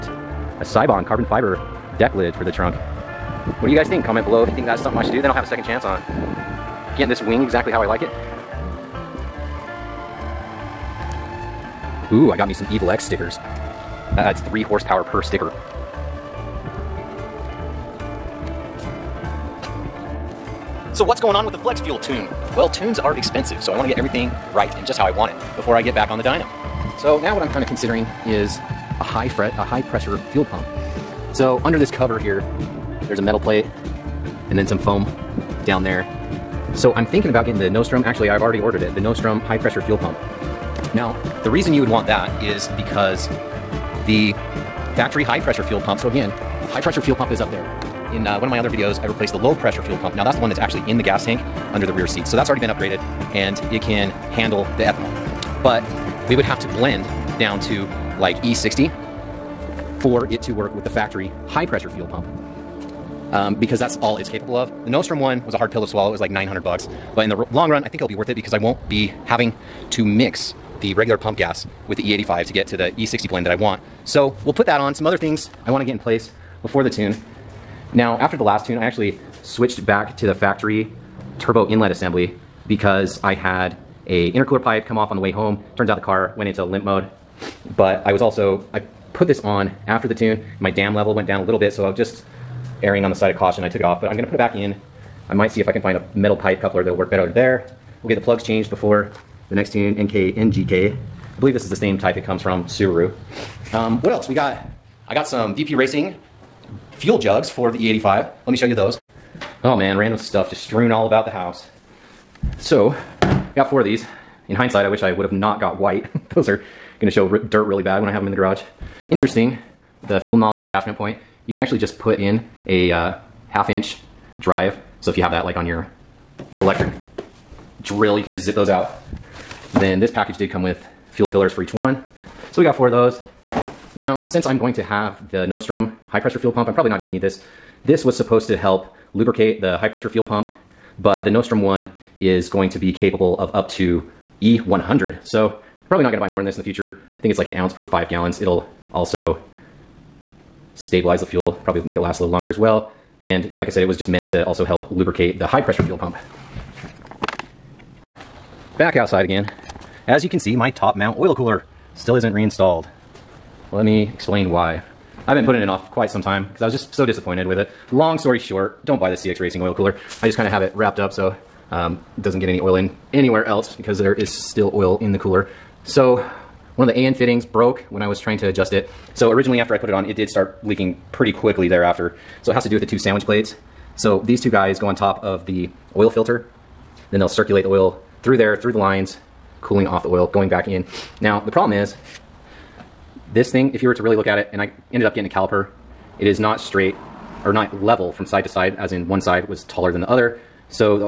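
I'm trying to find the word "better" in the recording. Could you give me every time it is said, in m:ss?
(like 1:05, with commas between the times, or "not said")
1:37.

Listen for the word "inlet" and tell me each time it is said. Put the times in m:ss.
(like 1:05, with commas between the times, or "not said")
1:21.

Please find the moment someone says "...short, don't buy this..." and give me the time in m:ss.
2:48.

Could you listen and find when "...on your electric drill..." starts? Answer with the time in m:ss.
2:05.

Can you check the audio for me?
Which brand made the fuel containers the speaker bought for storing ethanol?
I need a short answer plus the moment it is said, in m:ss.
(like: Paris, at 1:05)
VP Racing, at 1:45.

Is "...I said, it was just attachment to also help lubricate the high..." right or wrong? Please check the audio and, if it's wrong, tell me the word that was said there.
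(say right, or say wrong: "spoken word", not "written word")
wrong: "meant", not "attachment".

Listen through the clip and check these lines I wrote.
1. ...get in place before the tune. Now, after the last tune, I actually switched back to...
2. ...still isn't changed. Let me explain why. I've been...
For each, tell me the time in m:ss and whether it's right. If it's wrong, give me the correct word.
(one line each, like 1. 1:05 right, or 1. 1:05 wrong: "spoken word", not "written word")
1. 1:15 right
2. 2:41 wrong: "reinstalled", not "changed".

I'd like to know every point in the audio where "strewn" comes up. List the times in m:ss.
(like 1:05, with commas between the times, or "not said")
1:50.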